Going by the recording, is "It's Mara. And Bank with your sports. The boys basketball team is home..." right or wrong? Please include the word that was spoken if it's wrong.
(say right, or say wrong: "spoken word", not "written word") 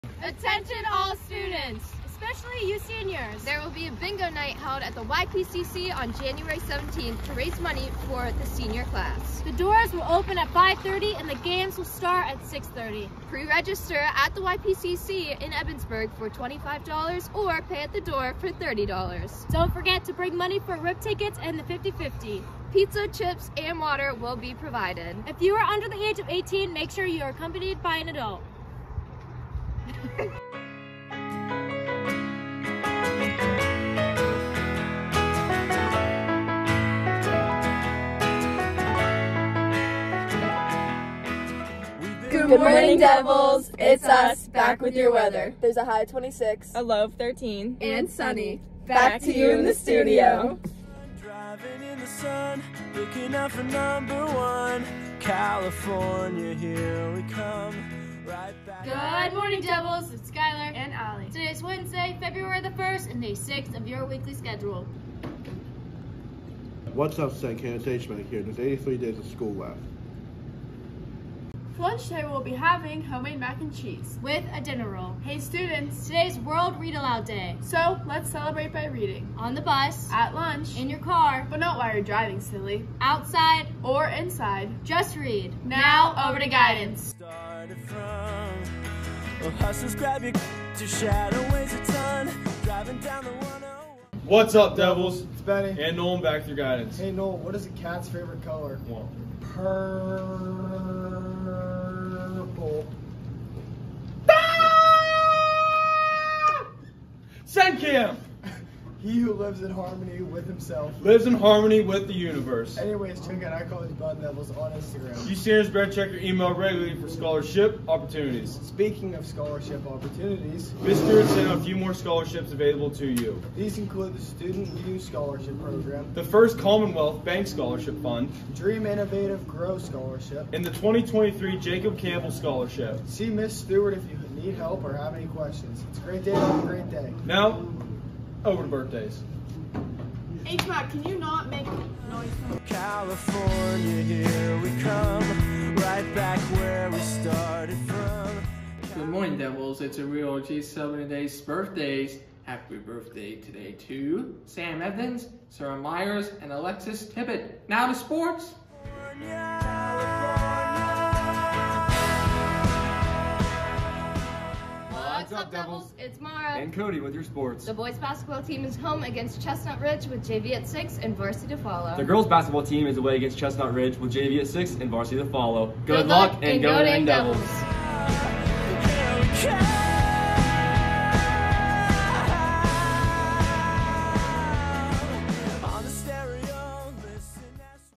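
wrong: "Cody", not "Bank".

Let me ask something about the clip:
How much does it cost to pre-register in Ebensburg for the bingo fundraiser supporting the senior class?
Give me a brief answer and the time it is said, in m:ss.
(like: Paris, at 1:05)
$25, at 0:16.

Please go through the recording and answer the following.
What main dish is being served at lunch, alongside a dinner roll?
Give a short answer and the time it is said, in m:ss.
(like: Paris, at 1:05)
Homemade mac and cheese, at 1:13.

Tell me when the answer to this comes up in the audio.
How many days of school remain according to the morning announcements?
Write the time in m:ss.
1:08.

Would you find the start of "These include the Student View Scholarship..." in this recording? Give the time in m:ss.
2:03.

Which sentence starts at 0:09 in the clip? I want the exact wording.
The doors will open at 5.30 and the games will start at 6.30.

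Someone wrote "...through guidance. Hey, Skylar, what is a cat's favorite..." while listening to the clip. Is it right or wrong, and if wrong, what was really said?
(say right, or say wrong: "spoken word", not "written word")
wrong: "Noel", not "Skylar".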